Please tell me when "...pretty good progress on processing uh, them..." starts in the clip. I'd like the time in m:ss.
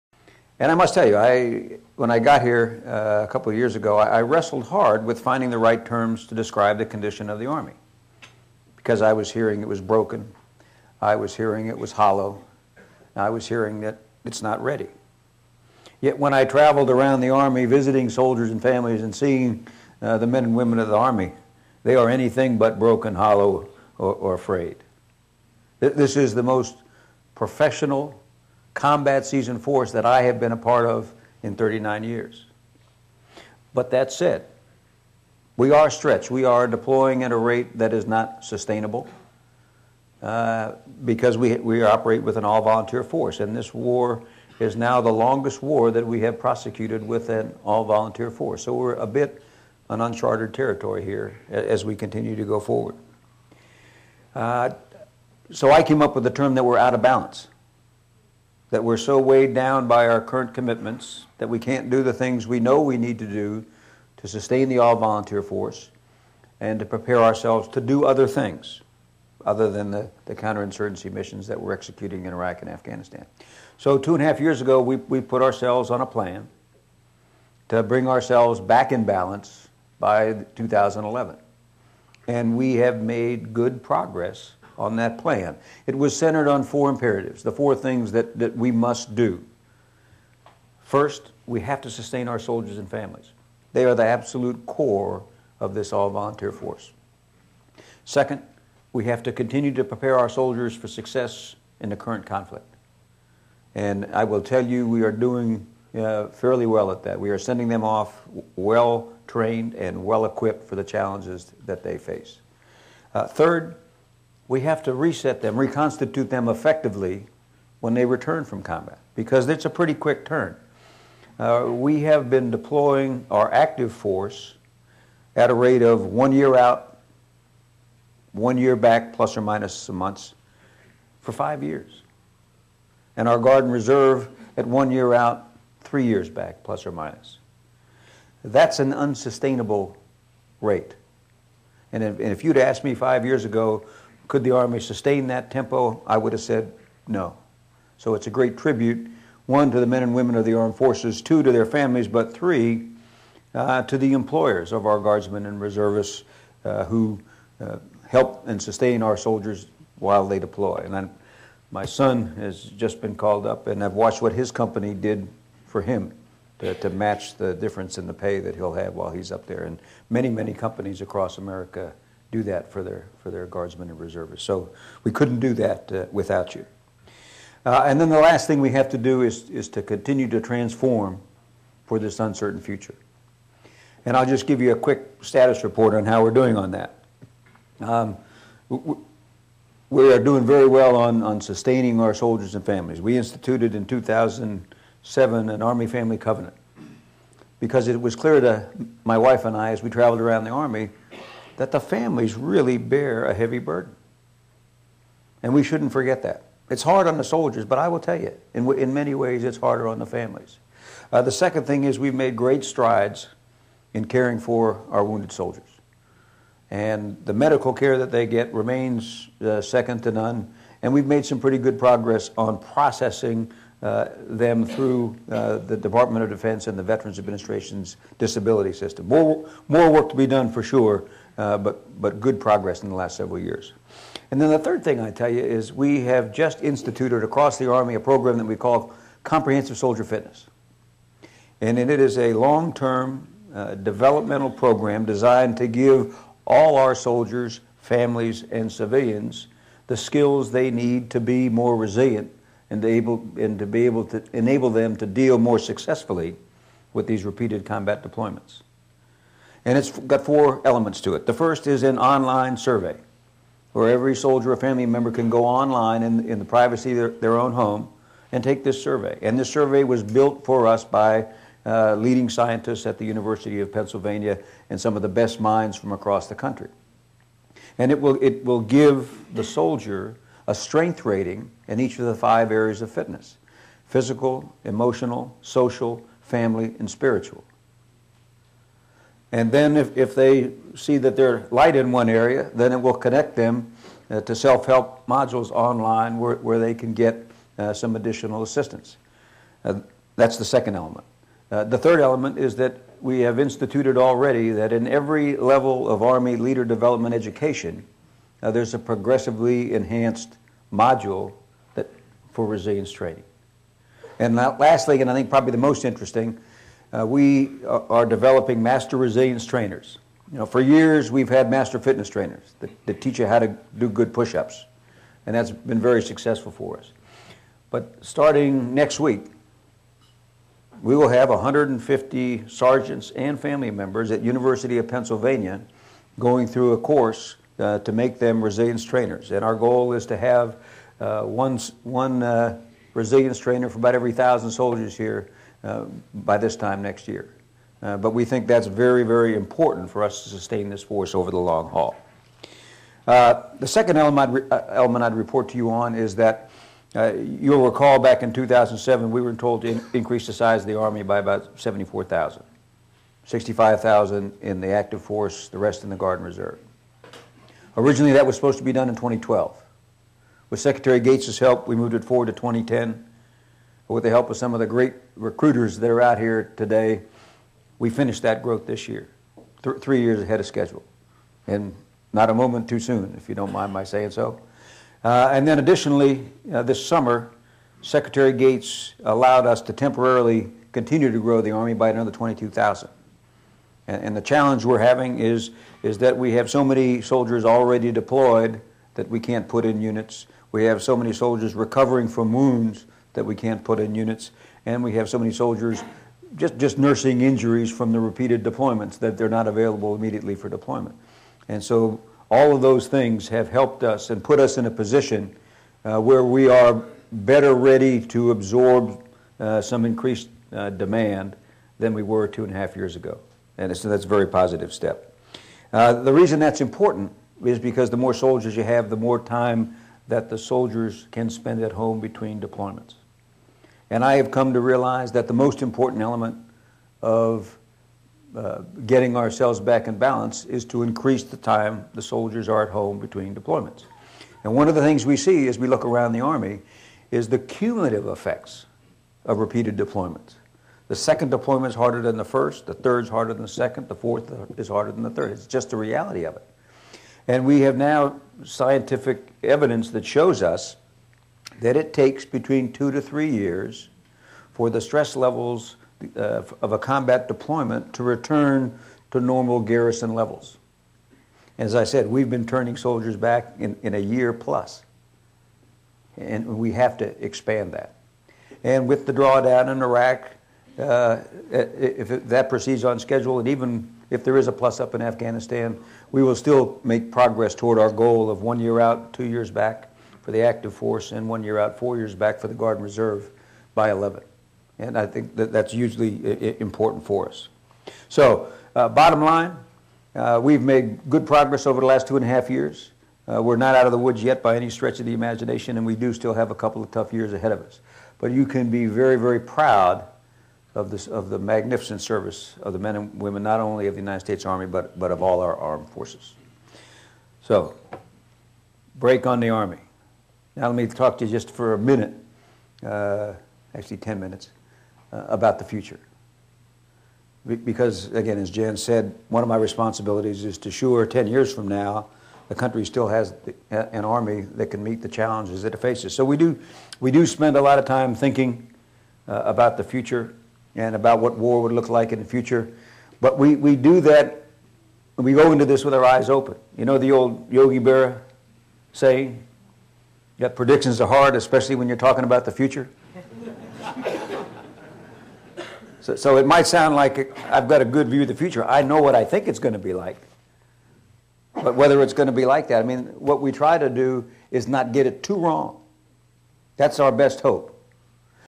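3:41.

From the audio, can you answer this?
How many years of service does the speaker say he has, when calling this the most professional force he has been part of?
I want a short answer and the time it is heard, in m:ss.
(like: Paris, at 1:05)
39, at 0:31.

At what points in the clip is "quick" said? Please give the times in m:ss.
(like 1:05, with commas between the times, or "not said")
1:59, 3:04.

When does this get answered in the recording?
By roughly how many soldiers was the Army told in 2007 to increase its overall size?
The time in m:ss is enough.
6:01.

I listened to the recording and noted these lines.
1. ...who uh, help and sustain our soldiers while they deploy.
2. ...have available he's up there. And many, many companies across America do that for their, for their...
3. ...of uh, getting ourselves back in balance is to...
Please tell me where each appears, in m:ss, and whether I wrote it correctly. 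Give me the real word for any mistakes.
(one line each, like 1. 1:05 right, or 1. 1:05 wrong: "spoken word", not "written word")
1. 2:36 right
2. 2:48 wrong: "while", not "available"
3. 7:17 right.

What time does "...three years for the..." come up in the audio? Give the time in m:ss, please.
7:43.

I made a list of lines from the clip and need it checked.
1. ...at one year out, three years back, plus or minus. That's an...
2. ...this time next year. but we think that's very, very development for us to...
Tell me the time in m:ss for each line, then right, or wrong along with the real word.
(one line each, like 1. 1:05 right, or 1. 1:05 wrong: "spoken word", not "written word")
1. 2:14 right
2. 5:46 wrong: "important", not "development".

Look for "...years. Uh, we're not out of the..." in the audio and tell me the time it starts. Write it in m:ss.
8:22.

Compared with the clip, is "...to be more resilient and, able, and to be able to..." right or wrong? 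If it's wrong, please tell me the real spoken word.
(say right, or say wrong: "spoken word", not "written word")
right.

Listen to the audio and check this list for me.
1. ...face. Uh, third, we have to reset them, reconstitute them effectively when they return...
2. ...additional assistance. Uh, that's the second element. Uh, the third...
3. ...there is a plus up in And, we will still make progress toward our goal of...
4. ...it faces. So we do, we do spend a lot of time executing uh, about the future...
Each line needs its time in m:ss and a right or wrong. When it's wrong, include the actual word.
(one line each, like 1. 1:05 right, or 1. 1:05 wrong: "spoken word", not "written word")
1. 1:51 right
2. 4:57 right
3. 8:04 wrong: "Afghanistan", not "And"
4. 8:55 wrong: "thinking", not "executing".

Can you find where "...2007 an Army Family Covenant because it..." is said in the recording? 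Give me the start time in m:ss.
3:13.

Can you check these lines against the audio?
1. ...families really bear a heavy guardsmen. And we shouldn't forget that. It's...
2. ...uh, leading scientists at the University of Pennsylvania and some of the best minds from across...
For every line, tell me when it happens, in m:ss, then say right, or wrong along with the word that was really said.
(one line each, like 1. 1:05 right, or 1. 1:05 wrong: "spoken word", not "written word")
1. 3:21 wrong: "burden", not "guardsmen"
2. 4:31 right.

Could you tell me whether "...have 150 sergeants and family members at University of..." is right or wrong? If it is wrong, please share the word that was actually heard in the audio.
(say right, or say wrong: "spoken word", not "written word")
right.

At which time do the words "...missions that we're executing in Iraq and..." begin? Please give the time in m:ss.
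1:11.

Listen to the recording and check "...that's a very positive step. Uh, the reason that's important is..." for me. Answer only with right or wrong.
right.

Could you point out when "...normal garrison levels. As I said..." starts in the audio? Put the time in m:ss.
7:49.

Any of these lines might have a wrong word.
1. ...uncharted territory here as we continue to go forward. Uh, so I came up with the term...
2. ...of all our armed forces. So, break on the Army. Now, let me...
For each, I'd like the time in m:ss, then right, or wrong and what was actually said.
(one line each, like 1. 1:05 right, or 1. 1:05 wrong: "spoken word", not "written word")
1. 0:50 right
2. 8:35 right.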